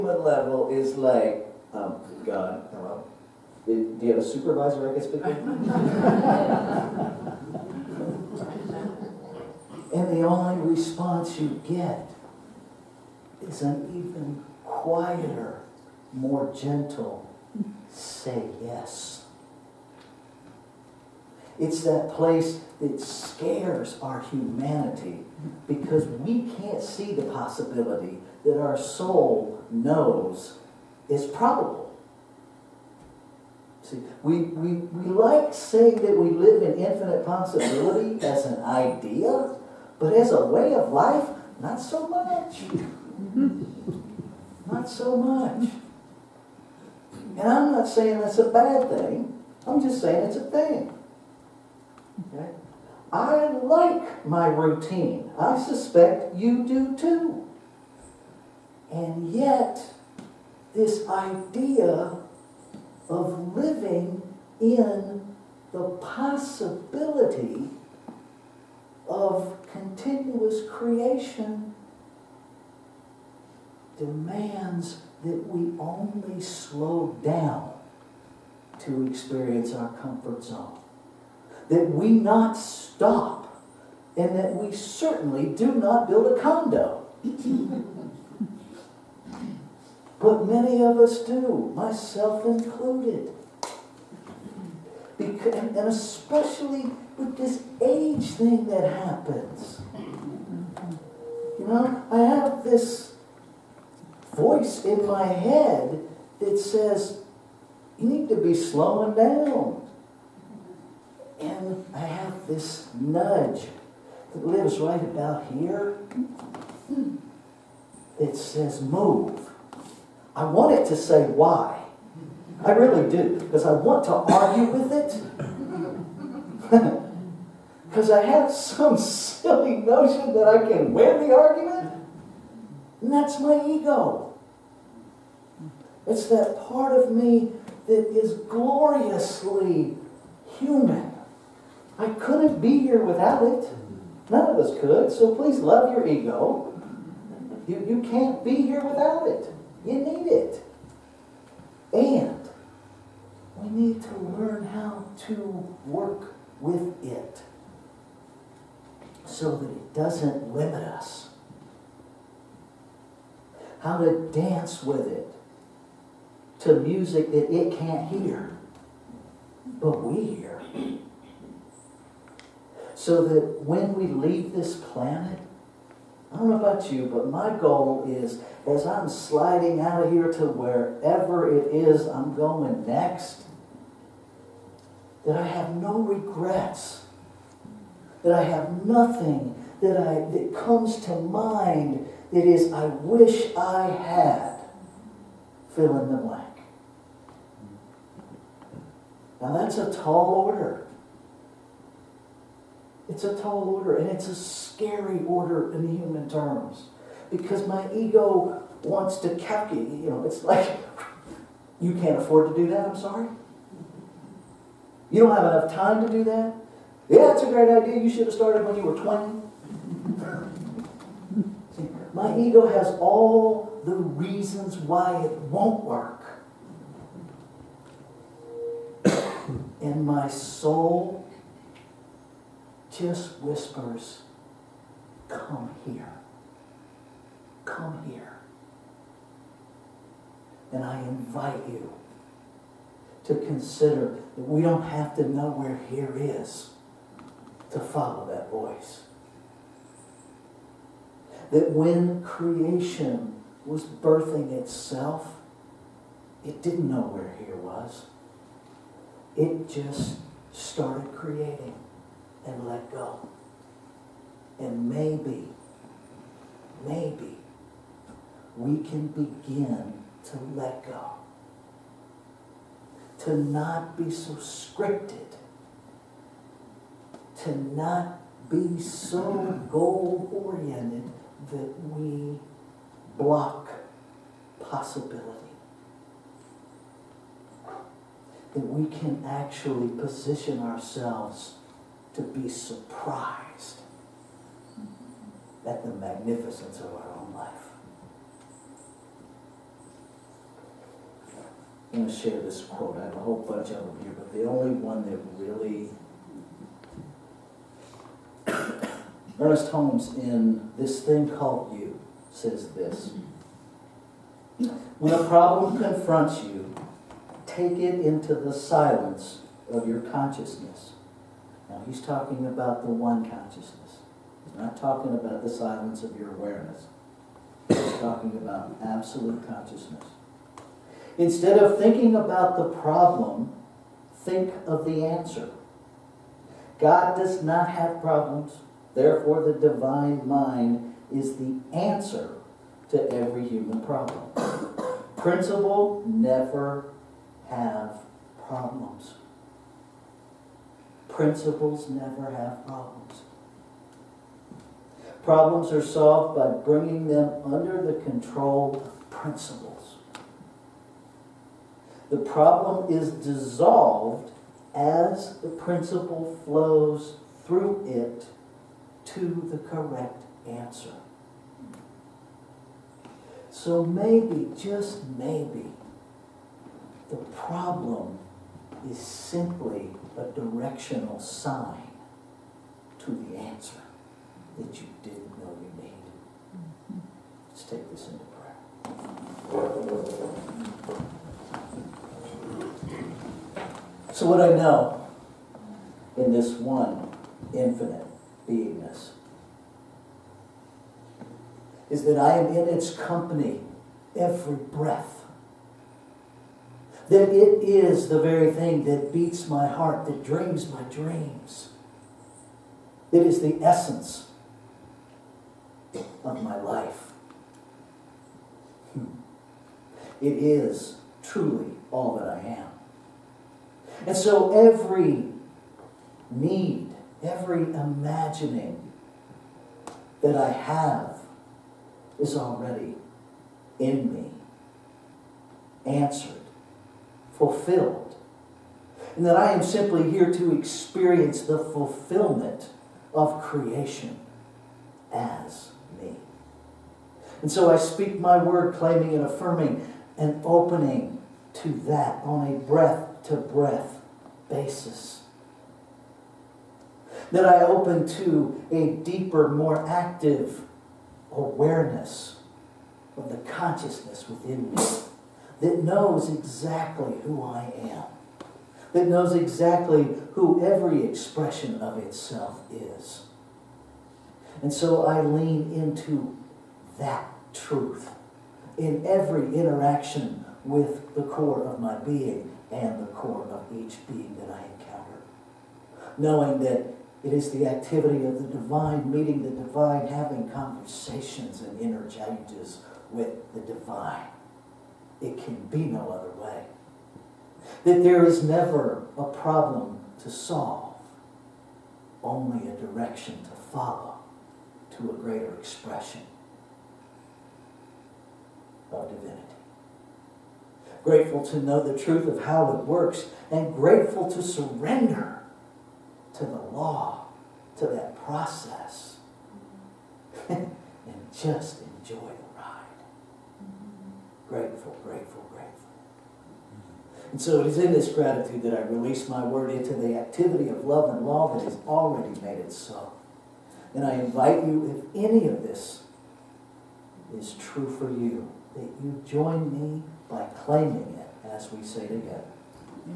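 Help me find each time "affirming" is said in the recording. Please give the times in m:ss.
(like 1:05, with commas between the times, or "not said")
7:29.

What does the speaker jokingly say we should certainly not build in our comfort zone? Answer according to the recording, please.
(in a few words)
a condo.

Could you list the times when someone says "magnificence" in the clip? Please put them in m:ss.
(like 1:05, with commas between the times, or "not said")
4:55.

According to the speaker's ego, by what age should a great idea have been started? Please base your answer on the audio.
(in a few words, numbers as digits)
20.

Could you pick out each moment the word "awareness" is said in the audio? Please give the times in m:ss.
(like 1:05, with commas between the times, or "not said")
5:26, 7:41.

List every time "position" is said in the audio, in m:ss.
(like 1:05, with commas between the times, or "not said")
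4:49.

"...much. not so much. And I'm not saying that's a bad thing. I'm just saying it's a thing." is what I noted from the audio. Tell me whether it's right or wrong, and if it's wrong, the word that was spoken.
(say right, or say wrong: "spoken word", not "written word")
right.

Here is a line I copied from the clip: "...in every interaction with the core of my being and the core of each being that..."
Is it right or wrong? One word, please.
right.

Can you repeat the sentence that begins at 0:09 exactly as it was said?
and the only response you get is an even quieter, more gentle say yes.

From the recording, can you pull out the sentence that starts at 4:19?
It just started creating and let go.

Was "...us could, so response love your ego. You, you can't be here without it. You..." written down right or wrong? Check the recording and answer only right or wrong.
wrong.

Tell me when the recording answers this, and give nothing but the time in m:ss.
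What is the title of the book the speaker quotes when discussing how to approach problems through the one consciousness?
5:10.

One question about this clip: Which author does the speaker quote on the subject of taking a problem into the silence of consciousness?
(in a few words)
Ernest Holmes.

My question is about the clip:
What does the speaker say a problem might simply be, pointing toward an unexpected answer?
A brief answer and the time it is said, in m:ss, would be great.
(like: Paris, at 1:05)
directional sign, at 6:20.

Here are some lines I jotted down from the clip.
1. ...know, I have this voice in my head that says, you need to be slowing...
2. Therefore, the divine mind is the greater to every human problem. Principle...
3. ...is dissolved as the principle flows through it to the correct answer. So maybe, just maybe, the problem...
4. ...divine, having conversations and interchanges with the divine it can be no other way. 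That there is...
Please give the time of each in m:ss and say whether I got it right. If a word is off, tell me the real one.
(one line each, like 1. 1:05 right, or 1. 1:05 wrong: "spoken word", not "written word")
1. 1:41 right
2. 5:38 wrong: "answer", not "greater"
3. 6:02 right
4. 8:09 right.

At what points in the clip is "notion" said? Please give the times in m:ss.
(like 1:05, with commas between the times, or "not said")
2:09.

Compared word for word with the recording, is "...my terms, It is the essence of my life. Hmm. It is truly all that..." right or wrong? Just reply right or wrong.
wrong.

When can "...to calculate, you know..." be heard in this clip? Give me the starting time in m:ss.
3:29.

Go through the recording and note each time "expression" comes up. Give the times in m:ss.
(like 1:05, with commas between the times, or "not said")
7:51, 8:25.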